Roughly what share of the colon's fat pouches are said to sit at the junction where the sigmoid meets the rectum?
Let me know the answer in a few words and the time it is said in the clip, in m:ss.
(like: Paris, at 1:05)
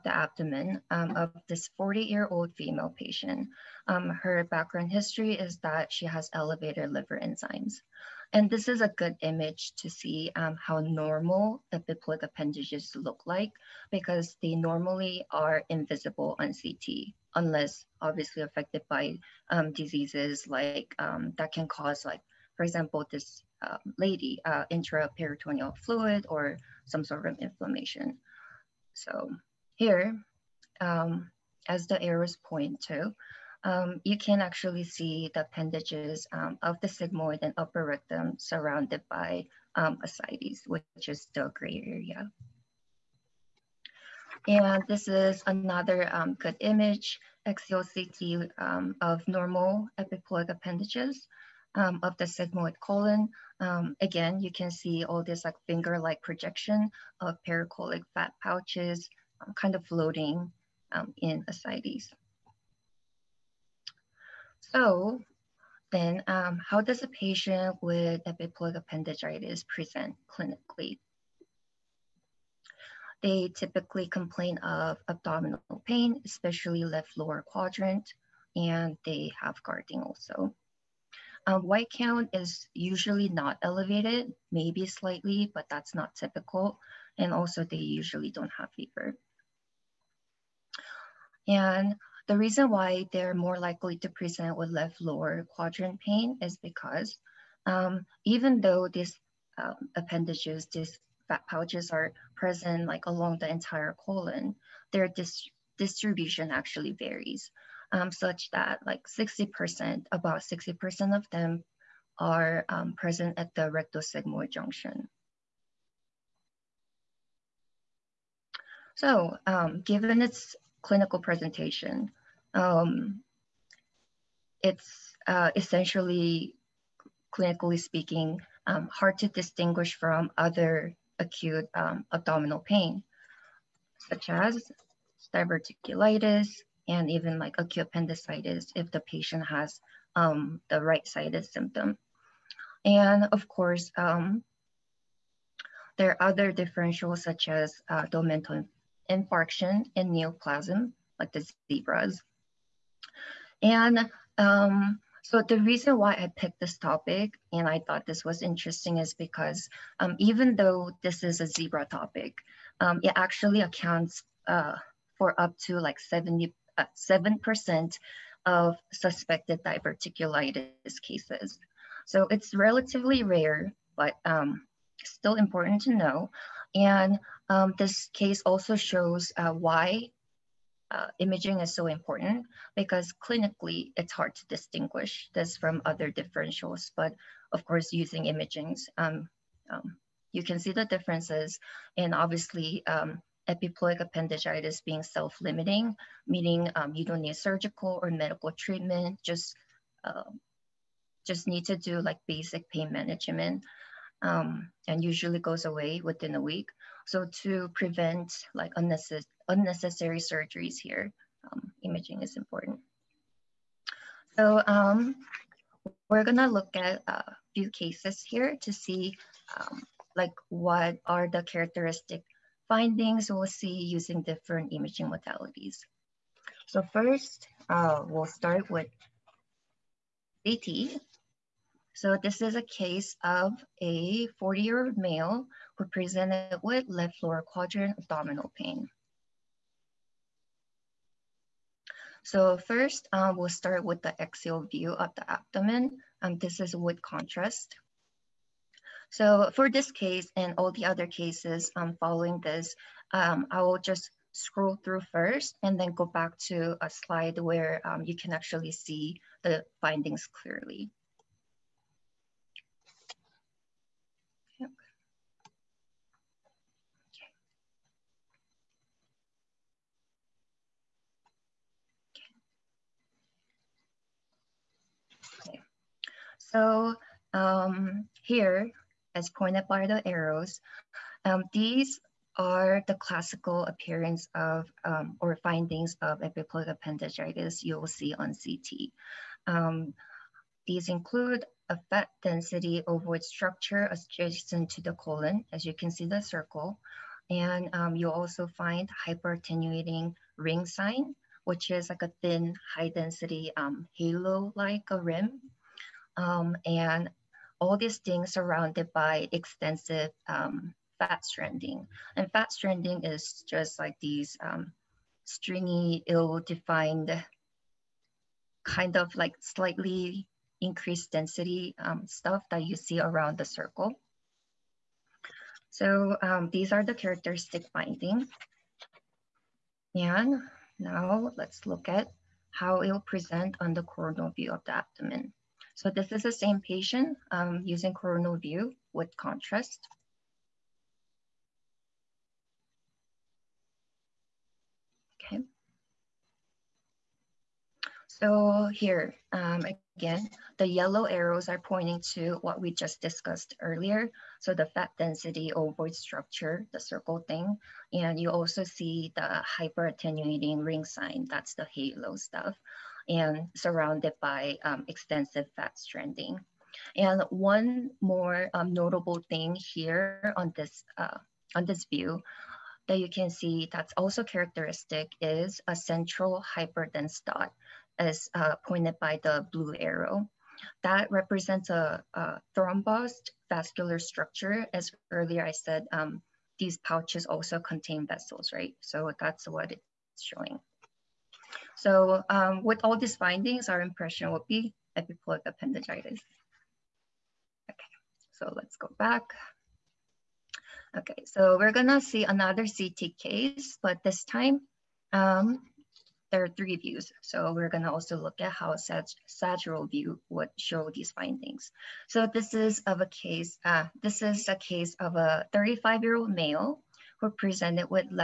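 60%, at 1:50.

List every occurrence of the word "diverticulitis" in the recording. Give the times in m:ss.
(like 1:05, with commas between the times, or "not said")
2:15, 2:49.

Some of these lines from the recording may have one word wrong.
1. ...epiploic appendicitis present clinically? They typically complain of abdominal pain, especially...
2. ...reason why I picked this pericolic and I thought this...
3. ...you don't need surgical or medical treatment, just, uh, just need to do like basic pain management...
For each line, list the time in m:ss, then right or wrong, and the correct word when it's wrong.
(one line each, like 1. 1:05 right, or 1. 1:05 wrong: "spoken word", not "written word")
1. 1:08 right
2. 2:35 wrong: "topic", not "pericolic"
3. 3:16 right.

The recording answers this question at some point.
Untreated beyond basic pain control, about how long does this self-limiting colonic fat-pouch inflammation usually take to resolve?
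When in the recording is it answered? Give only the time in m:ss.
3:26.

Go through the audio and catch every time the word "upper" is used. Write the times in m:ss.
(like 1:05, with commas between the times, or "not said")
0:37.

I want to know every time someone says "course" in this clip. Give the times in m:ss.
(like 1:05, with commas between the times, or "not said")
2:23, 3:07.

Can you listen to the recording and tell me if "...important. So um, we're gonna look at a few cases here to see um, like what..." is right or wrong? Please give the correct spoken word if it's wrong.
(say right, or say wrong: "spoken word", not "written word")
right.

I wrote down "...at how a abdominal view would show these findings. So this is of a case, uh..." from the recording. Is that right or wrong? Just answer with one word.
wrong.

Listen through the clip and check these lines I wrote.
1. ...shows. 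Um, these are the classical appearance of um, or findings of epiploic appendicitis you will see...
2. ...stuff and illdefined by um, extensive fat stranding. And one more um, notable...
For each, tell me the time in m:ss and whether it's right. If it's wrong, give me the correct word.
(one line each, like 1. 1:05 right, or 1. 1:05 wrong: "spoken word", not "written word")
1. 4:40 wrong: "arrows", not "shows"
2. 6:02 wrong: "surrounded", not "illdefined".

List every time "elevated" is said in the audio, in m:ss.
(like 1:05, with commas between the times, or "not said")
0:06, 1:23.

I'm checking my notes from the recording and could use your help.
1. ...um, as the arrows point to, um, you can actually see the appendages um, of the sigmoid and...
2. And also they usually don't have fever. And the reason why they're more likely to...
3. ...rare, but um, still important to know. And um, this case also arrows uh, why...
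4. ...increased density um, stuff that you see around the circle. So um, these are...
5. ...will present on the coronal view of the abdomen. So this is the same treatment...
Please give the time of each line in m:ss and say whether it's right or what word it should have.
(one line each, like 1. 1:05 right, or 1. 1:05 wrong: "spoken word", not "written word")
1. 0:30 right
2. 1:27 right
3. 2:53 wrong: "shows", not "arrows"
4. 5:20 right
5. 5:32 wrong: "patient", not "treatment".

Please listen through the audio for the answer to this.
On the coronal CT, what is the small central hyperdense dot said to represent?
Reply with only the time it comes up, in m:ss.
6:22.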